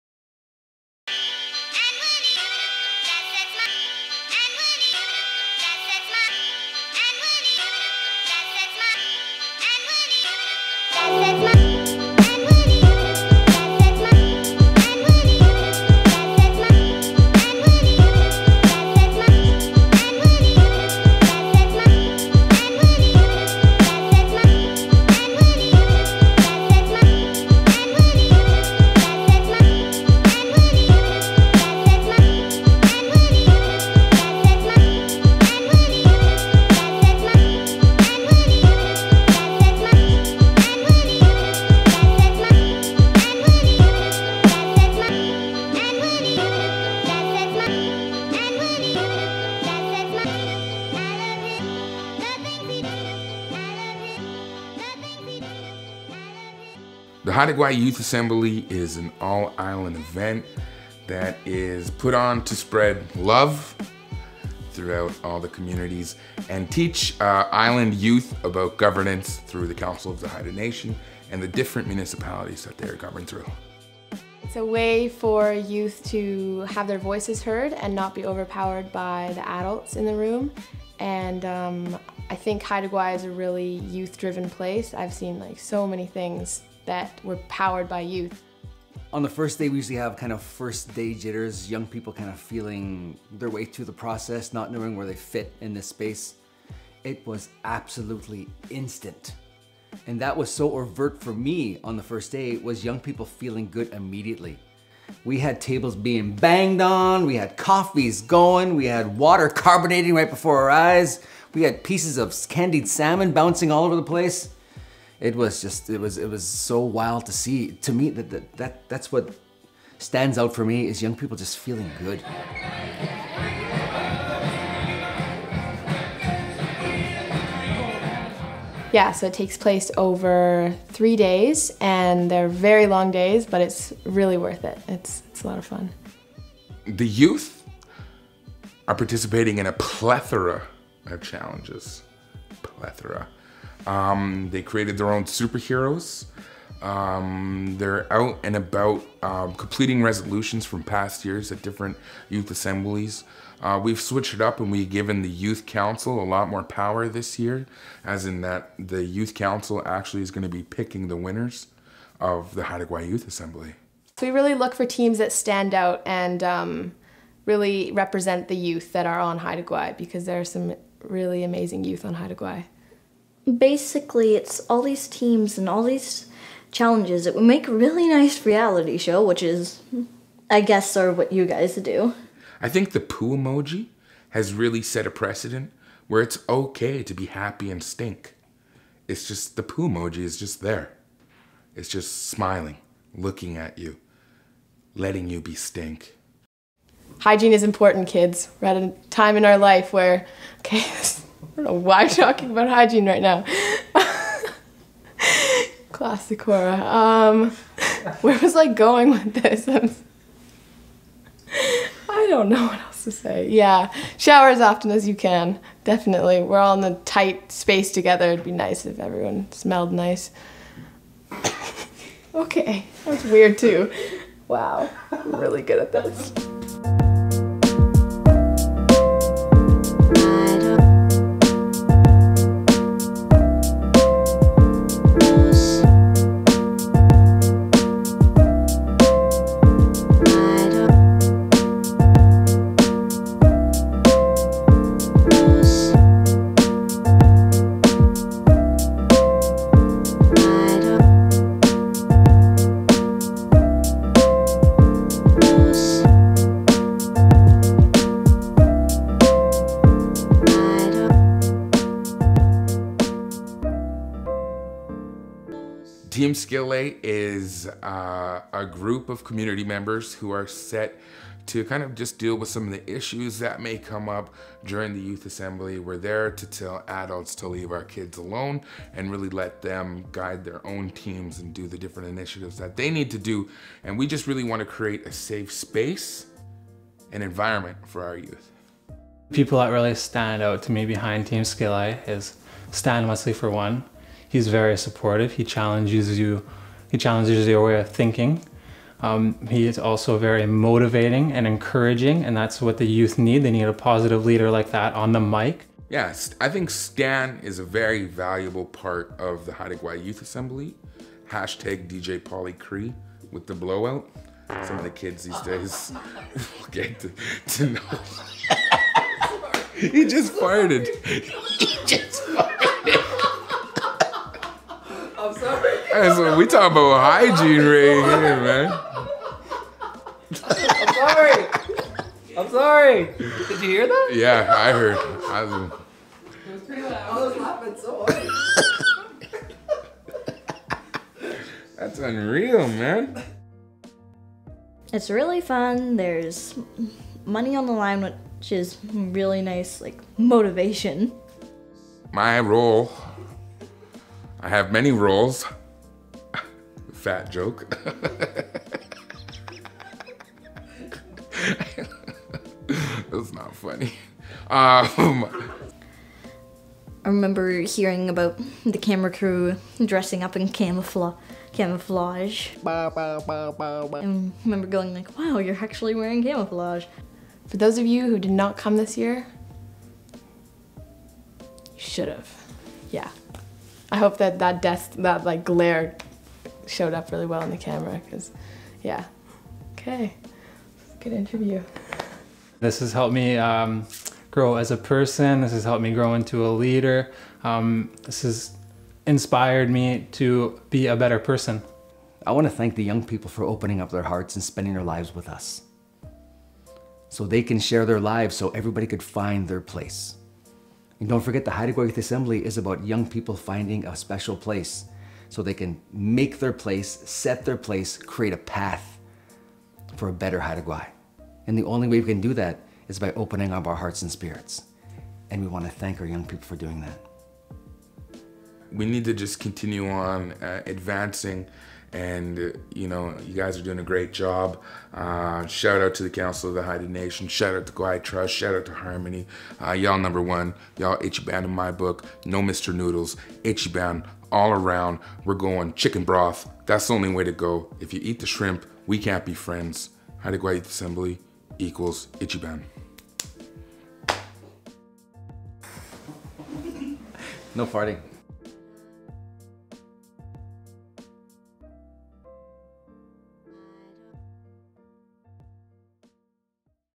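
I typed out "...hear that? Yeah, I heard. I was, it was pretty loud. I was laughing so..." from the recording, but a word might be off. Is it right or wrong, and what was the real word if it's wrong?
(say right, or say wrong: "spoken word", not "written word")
right.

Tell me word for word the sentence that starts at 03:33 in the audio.
Yeah, shower as often as you can.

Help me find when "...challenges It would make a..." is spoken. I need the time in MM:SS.
02:56.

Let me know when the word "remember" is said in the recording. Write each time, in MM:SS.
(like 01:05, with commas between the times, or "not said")
06:07, 06:14.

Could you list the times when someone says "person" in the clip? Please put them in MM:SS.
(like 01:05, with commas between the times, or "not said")
06:34, 06:41.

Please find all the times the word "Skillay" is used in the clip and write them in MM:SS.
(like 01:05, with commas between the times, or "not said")
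04:26, 04:51.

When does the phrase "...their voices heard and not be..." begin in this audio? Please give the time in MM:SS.
01:16.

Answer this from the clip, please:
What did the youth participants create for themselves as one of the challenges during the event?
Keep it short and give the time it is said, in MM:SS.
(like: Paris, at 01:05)
superheroes, at 02:25.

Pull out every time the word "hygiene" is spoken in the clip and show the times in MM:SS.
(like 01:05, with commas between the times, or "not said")
03:17, 03:22, 05:26.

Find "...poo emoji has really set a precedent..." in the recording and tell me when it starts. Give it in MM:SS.
03:03.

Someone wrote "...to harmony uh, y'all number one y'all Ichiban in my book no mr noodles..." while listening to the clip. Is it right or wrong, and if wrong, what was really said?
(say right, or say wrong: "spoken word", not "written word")
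right.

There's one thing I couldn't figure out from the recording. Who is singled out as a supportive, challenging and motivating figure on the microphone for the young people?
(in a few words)
Stan Wesley.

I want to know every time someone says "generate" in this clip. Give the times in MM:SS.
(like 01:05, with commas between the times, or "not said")
not said.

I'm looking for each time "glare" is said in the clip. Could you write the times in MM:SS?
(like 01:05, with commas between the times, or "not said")
06:25.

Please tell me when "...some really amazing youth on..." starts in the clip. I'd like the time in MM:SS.
02:50.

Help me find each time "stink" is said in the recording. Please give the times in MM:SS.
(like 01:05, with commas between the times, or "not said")
03:07, 03:15.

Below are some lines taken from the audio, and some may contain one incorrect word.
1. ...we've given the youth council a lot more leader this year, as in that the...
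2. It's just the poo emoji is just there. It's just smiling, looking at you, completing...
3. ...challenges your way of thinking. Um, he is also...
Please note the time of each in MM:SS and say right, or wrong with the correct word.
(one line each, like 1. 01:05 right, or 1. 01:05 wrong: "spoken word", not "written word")
1. 02:34 wrong: "power", not "leader"
2. 03:09 wrong: "letting", not "completing"
3. 04:56 right.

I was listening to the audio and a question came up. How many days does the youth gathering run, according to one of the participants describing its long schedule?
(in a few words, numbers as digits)
3.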